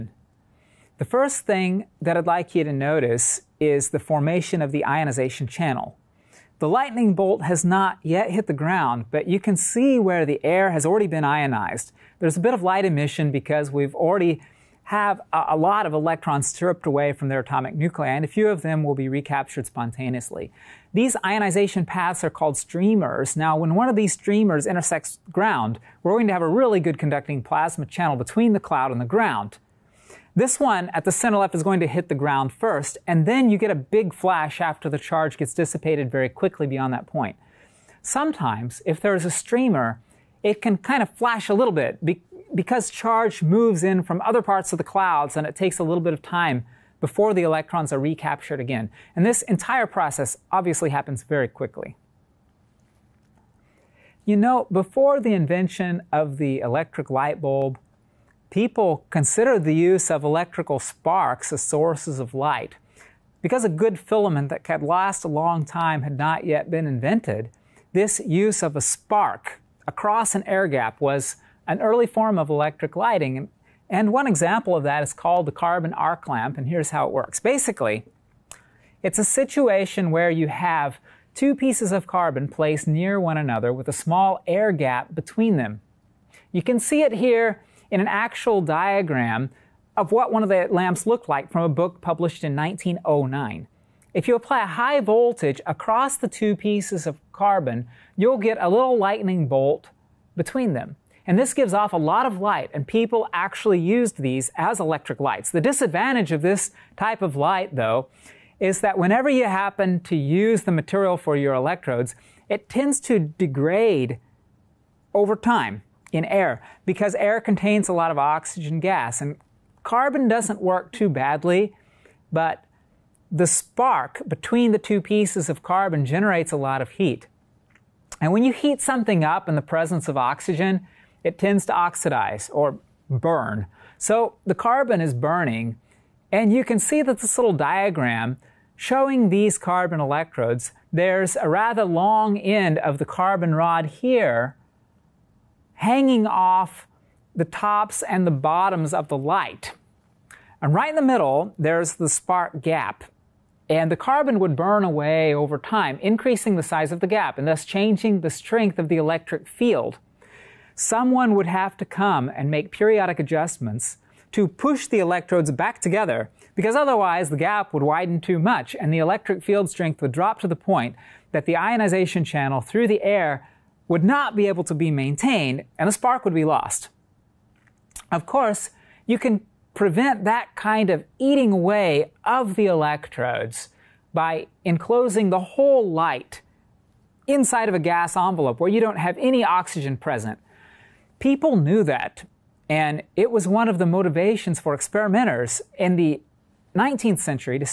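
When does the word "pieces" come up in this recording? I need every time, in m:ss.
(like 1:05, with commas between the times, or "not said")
1:21, 1:36, 2:05.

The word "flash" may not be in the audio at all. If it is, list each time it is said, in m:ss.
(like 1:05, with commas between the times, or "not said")
0:34, 0:41.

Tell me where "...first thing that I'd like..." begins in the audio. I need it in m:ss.
0:01.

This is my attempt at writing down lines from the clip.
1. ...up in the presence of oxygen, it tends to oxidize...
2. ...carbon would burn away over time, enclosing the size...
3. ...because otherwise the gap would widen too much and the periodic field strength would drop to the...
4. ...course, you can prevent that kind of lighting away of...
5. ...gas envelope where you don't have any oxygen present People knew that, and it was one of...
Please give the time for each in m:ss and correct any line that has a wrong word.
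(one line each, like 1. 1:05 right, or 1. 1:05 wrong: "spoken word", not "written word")
1. 2:09 right
2. 2:33 wrong: "increasing", not "enclosing"
3. 2:46 wrong: "electric", not "periodic"
4. 2:58 wrong: "eating", not "lighting"
5. 3:07 right.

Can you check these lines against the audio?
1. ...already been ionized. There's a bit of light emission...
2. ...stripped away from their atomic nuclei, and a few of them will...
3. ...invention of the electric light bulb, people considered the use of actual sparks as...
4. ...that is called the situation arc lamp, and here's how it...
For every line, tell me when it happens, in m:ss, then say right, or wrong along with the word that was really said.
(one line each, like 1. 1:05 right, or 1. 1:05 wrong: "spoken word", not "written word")
1. 0:10 right
2. 0:16 right
3. 0:55 wrong: "electrical", not "actual"
4. 1:14 wrong: "carbon", not "situation".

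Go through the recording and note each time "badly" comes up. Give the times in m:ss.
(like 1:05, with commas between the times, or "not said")
2:01.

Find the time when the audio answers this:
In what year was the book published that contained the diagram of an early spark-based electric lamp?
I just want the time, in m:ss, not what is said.
1:32.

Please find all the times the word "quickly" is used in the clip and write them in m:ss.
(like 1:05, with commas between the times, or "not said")
0:36, 0:51.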